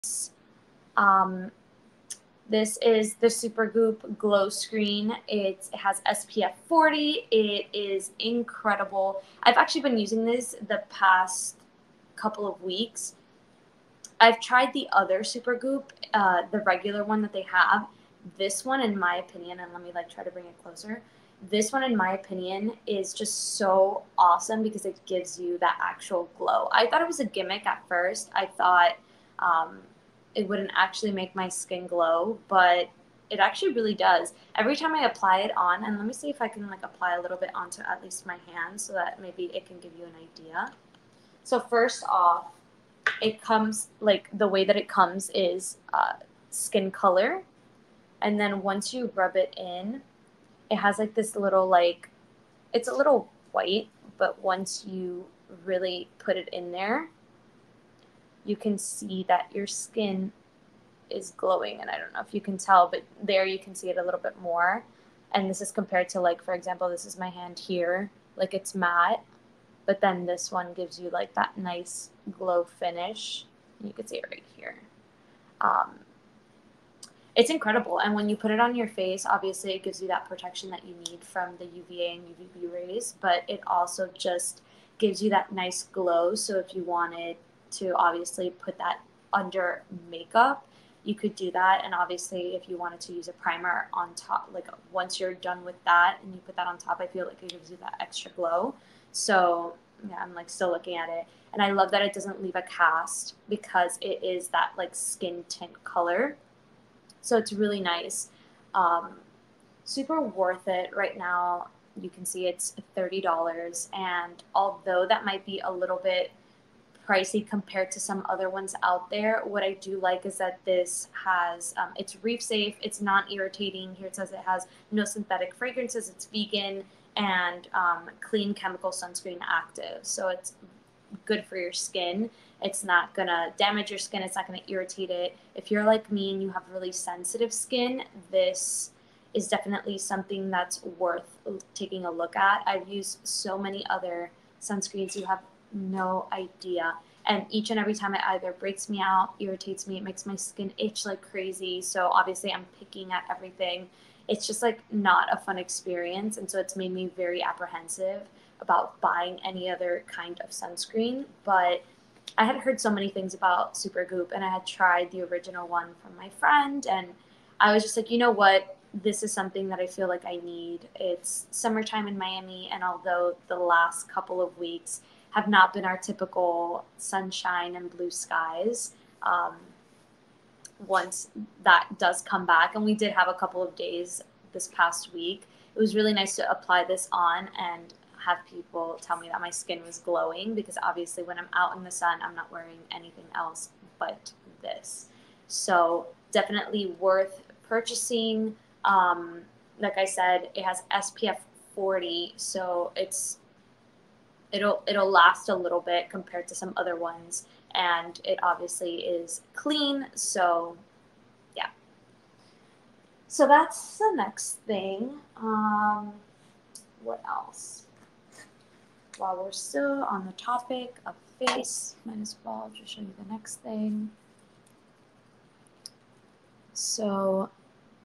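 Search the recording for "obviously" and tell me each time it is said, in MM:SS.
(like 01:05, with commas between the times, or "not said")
01:19, 01:27, 01:31, 02:32, 03:10, 03:28.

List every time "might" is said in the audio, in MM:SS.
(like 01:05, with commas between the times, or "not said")
01:55, 03:42.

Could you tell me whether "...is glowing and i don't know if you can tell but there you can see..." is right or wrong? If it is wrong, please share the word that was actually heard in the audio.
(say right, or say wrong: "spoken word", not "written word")
right.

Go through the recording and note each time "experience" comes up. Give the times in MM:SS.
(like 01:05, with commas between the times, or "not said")
02:35.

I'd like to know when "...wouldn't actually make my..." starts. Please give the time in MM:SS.
00:30.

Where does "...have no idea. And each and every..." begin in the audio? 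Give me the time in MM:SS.
02:25.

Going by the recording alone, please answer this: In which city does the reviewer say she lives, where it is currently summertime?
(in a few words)
Miami.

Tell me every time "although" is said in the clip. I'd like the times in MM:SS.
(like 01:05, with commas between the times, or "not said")
01:54, 02:52.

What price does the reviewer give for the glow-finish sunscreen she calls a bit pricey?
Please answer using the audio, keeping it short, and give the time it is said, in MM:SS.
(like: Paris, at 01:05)
$30, at 01:52.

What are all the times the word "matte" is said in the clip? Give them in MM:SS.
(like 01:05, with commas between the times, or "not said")
01:08.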